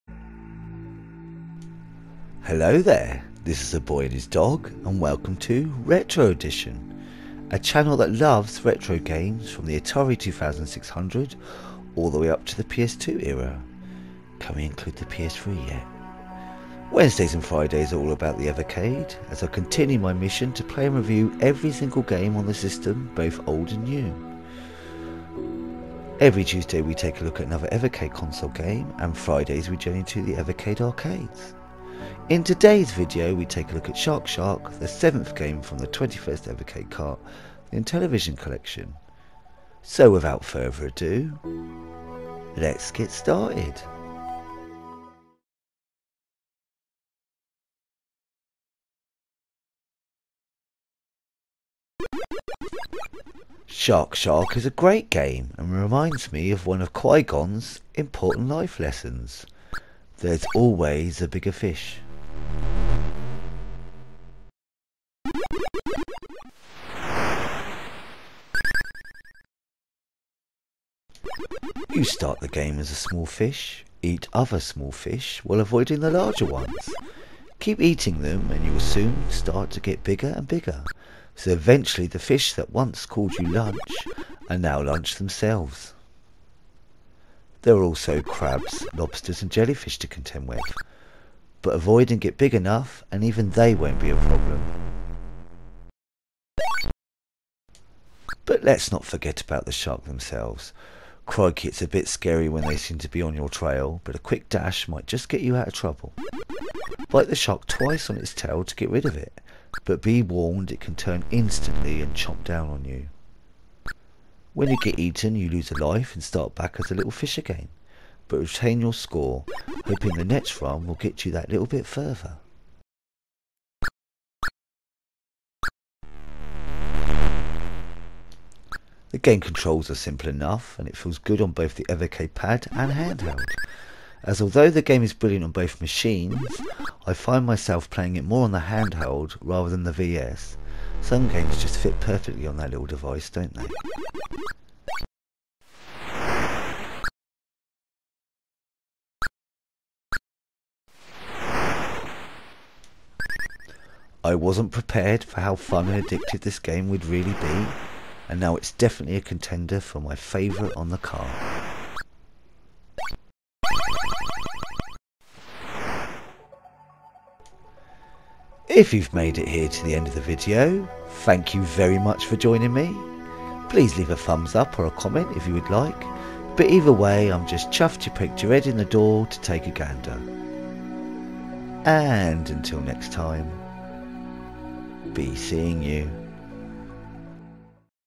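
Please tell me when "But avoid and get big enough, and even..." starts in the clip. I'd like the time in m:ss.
1:31.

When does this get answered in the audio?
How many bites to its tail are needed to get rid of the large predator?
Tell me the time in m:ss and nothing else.
1:47.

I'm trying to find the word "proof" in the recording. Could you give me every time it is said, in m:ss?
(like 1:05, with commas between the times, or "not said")
not said.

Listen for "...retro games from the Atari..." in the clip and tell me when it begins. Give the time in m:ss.
0:08.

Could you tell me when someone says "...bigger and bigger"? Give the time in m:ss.
1:20.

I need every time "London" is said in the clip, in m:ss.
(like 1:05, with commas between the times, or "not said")
not said.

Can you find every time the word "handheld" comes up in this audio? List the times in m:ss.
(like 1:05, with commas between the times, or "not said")
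2:12, 2:18.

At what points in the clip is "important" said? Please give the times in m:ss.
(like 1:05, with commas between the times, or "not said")
0:57.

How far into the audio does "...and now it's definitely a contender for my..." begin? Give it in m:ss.
2:38.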